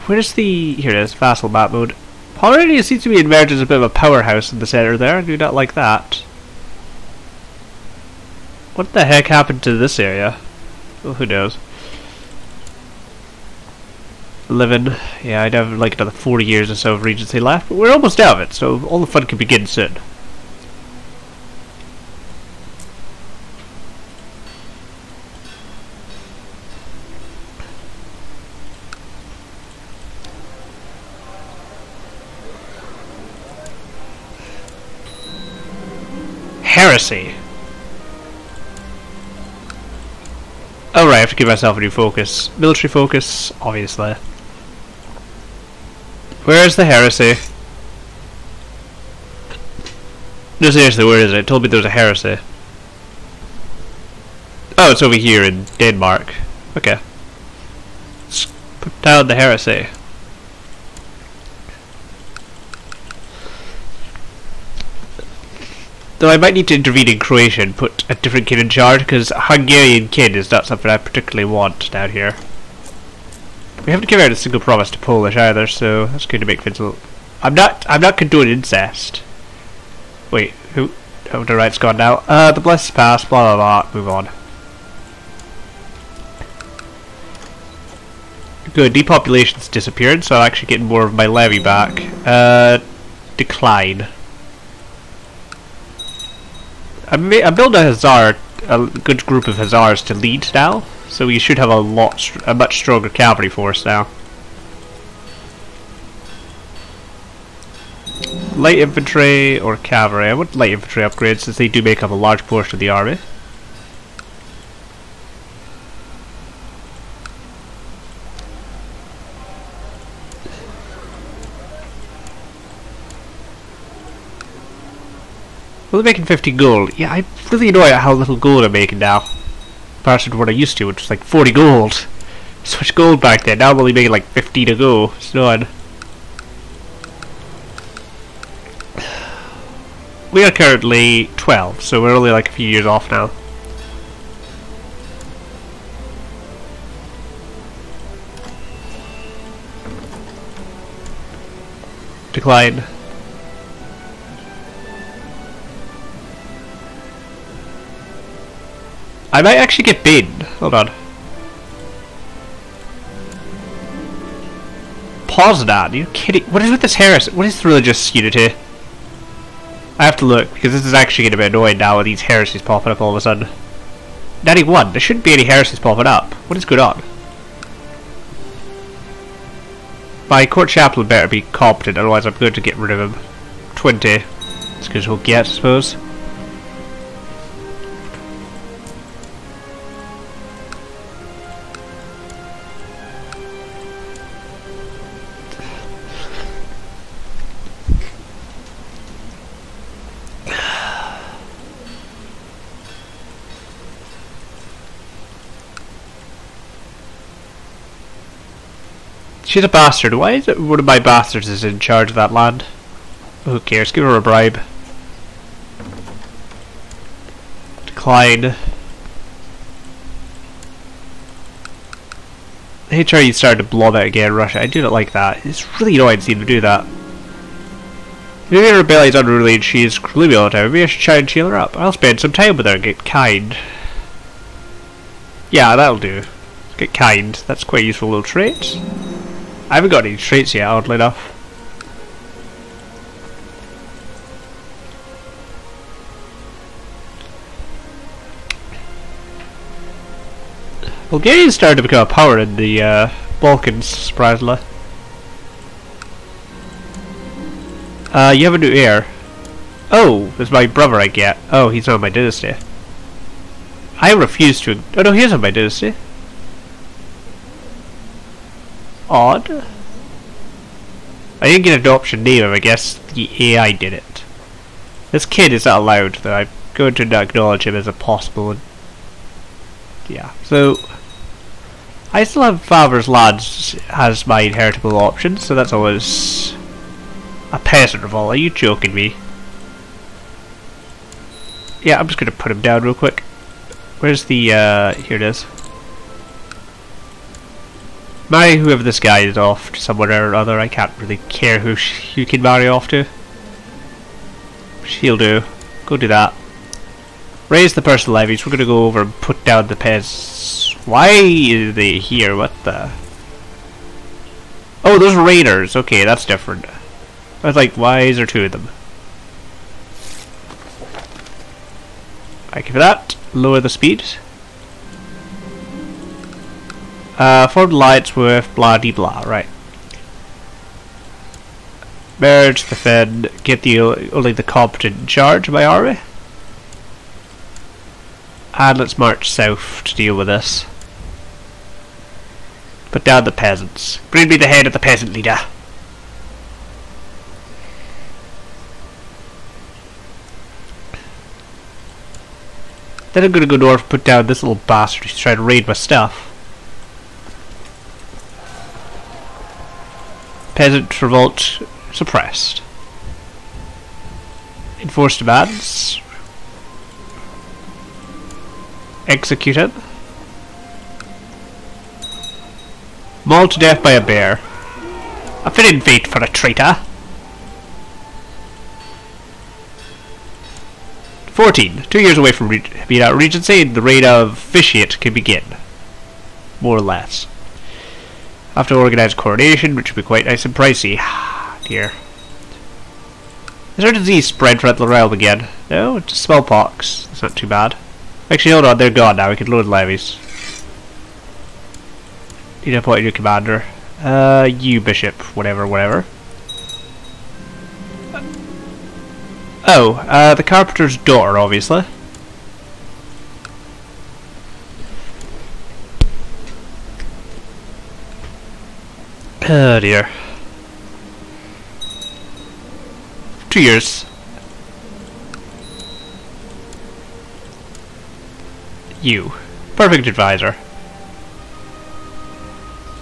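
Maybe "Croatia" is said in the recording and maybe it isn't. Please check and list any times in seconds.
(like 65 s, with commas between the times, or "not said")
67 s.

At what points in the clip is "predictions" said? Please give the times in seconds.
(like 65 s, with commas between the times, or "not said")
not said.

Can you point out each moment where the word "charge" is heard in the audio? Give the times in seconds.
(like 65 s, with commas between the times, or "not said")
68 s, 211 s, 335 s.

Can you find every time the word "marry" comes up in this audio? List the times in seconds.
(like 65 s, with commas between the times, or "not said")
298 s, 302 s.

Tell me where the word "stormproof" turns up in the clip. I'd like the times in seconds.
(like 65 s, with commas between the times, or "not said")
not said.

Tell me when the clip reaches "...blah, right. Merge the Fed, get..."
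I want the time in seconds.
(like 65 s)
328 s.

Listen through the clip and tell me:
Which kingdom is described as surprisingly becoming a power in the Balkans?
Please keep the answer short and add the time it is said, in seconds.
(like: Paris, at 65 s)
Bulgaria, at 251 s.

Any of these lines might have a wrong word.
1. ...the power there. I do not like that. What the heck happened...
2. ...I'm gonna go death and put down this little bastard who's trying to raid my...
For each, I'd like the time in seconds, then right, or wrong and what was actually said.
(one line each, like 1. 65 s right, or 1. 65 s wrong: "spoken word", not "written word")
1. 4 s wrong: "center", not "power"
2. 353 s wrong: "north", not "death".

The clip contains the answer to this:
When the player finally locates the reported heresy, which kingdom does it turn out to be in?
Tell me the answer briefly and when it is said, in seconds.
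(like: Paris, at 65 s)
Denmark, at 55 s.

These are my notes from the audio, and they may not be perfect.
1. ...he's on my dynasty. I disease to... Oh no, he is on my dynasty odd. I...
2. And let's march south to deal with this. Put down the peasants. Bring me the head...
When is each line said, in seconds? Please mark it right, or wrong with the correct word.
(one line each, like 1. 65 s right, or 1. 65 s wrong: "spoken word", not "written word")
1. 261 s wrong: "refuse", not "disease"
2. 338 s right.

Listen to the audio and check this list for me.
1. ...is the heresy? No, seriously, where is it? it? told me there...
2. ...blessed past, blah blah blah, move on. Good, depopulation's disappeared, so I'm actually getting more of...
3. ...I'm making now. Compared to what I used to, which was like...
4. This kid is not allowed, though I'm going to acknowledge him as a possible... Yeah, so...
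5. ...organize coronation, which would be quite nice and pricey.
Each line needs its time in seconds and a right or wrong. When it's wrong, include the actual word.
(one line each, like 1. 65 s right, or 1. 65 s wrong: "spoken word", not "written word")
1. 46 s right
2. 82 s right
3. 128 s right
4. 275 s right
5. 388 s right.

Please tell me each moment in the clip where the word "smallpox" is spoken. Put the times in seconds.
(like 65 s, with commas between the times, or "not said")
396 s.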